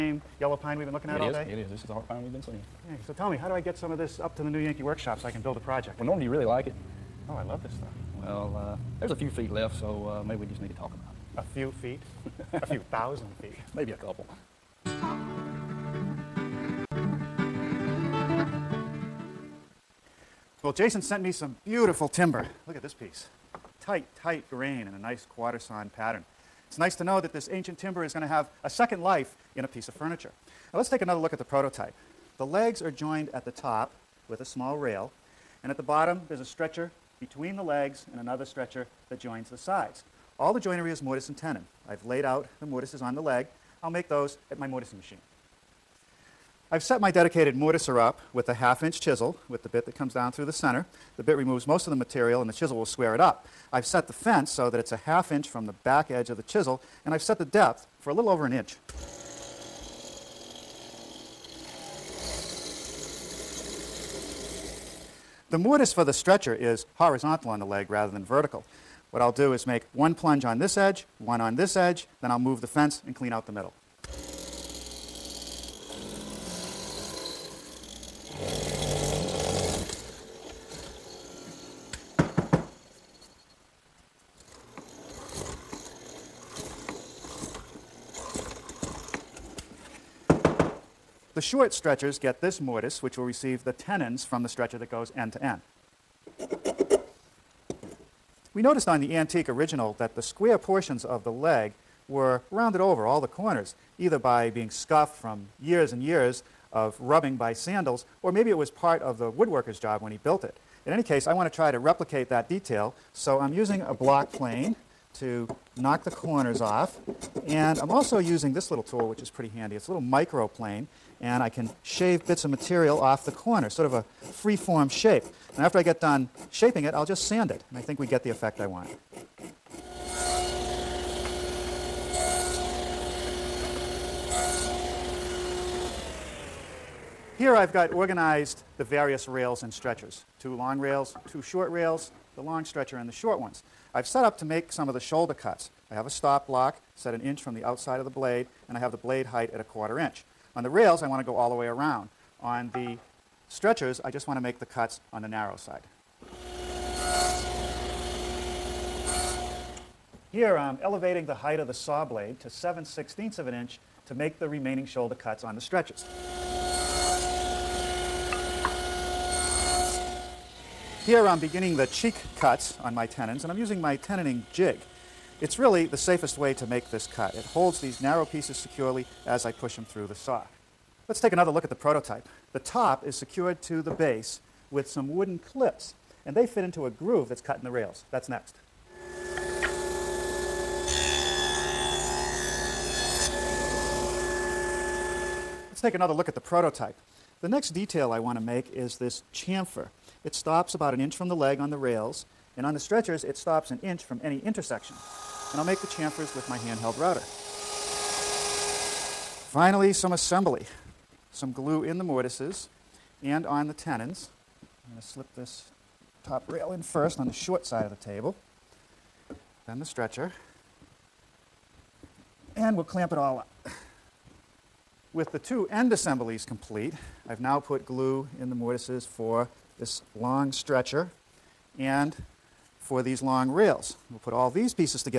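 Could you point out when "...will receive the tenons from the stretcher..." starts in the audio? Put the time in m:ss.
1:33.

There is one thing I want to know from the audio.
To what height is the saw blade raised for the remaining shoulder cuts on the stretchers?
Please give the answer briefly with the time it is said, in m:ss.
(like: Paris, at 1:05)
7/16 inch, at 2:42.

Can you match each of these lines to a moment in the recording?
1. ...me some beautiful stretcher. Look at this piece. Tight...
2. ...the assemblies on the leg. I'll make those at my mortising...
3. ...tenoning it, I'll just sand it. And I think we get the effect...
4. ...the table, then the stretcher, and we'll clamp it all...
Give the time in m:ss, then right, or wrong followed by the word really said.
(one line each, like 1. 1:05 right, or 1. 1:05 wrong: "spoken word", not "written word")
1. 0:21 wrong: "timber", not "stretcher"
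2. 0:42 wrong: "mortises", not "assemblies"
3. 2:06 wrong: "shaping", not "tenoning"
4. 3:37 right.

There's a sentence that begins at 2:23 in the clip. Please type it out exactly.
I've set up to make some of the shoulder cuts.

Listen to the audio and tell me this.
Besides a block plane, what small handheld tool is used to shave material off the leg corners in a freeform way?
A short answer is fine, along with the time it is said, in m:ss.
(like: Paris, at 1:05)
Microplane, at 2:00.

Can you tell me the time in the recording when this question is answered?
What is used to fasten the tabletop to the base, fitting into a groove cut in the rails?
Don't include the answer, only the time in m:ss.
3:05.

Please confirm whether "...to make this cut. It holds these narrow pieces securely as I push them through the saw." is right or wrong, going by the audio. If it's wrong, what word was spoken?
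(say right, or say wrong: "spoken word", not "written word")
right.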